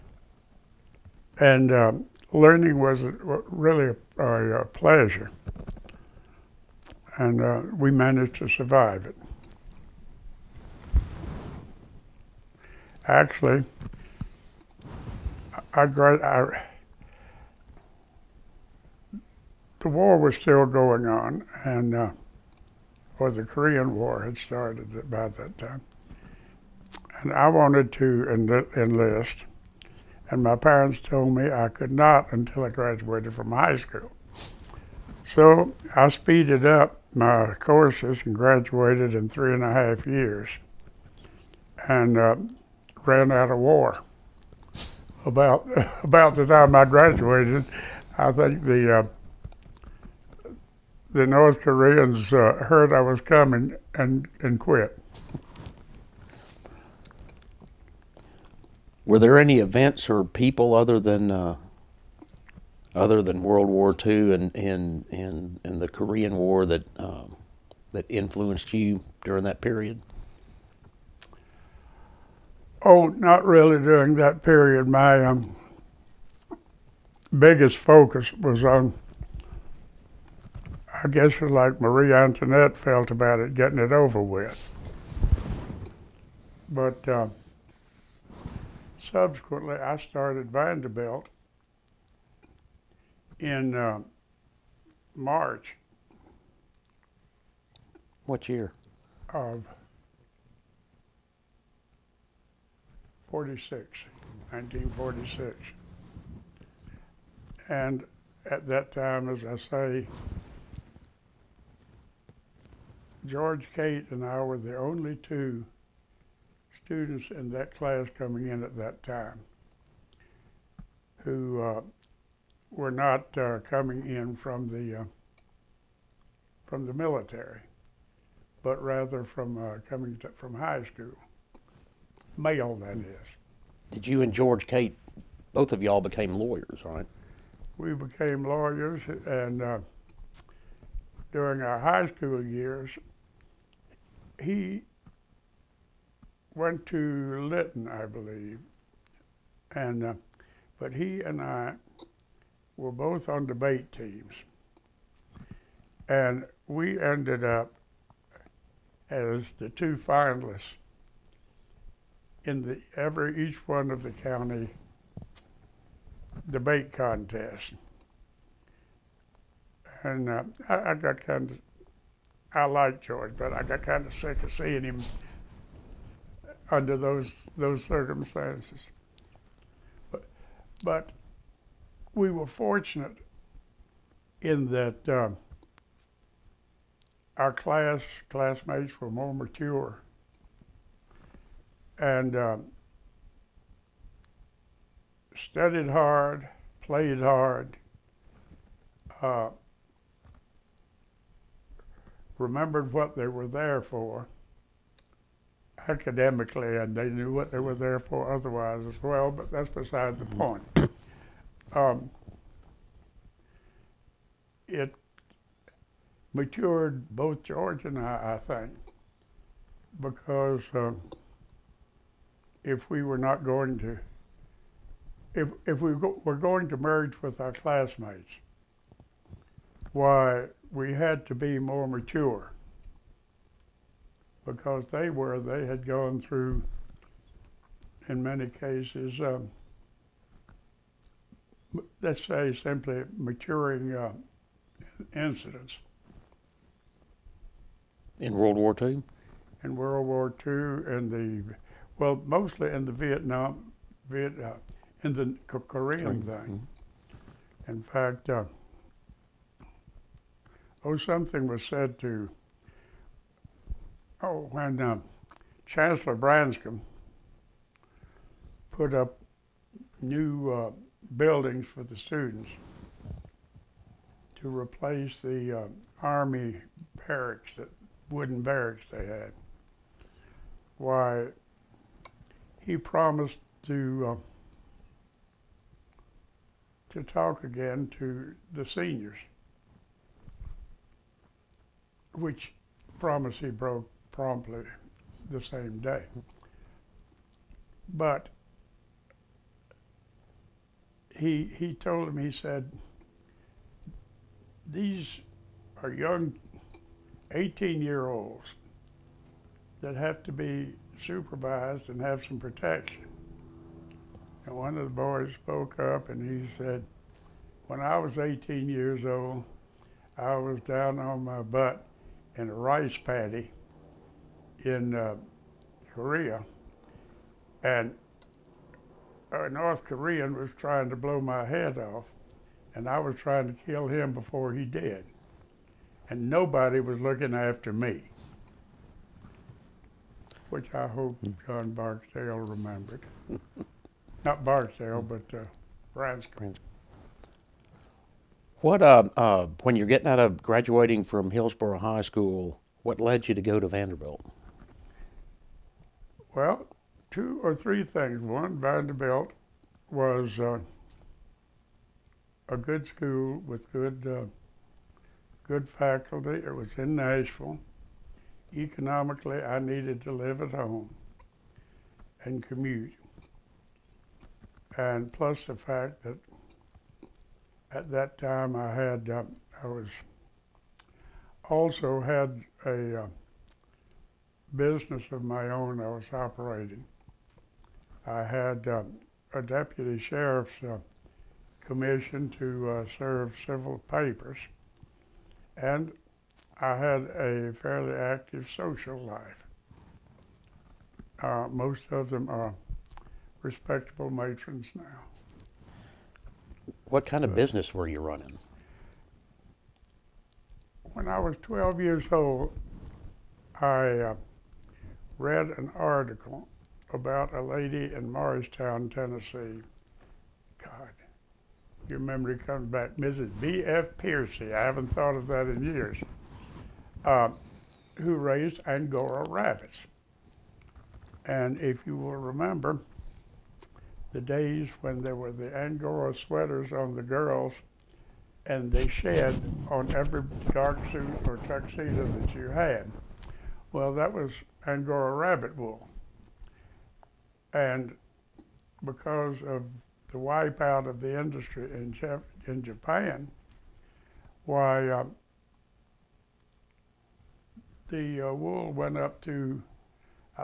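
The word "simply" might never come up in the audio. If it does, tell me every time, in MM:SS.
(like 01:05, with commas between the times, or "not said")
04:02.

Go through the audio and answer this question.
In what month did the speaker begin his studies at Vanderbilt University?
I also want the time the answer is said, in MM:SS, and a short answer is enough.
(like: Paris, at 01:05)
March, at 01:35.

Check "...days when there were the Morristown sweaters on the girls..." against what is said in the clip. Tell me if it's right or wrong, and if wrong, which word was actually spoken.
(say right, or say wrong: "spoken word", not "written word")
wrong: "Angora", not "Morristown".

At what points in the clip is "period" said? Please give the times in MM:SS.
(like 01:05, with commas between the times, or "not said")
01:09, 01:14.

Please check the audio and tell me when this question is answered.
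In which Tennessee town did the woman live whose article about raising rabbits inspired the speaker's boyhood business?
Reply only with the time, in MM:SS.
06:58.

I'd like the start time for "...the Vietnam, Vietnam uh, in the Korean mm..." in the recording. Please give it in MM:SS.
04:12.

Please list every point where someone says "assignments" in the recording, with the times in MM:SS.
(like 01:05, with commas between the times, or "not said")
not said.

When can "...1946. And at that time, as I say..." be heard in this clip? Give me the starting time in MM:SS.
01:44.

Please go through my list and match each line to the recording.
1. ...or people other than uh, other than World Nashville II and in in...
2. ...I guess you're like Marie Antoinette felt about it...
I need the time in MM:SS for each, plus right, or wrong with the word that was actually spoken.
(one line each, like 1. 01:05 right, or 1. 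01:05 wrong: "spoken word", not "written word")
1. 01:00 wrong: "War", not "Nashville"
2. 01:21 right.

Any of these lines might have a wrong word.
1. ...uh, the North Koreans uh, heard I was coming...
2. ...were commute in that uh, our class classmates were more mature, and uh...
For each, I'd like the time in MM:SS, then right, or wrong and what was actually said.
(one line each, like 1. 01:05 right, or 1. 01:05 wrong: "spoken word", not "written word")
1. 00:48 right
2. 03:02 wrong: "fortunate", not "commute".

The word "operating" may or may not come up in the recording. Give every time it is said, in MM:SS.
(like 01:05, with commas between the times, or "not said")
06:26.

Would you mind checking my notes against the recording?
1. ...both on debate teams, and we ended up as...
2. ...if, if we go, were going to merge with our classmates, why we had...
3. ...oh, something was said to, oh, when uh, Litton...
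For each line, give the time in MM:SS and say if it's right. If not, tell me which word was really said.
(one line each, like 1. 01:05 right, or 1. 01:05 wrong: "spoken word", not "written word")
1. 02:32 right
2. 03:45 right
3. 04:20 wrong: "Chancellor", not "Litton".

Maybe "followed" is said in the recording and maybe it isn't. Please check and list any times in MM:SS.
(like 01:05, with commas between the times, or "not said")
not said.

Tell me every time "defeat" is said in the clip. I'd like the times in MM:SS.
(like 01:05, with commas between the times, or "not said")
not said.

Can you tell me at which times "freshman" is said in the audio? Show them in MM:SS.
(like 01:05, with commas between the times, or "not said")
not said.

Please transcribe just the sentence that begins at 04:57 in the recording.
But he, he told him, he said, these are young 18 year olds that have to be supervised and have some protection.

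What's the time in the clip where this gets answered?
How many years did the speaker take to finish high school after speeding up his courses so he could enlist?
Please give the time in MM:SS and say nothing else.
00:39.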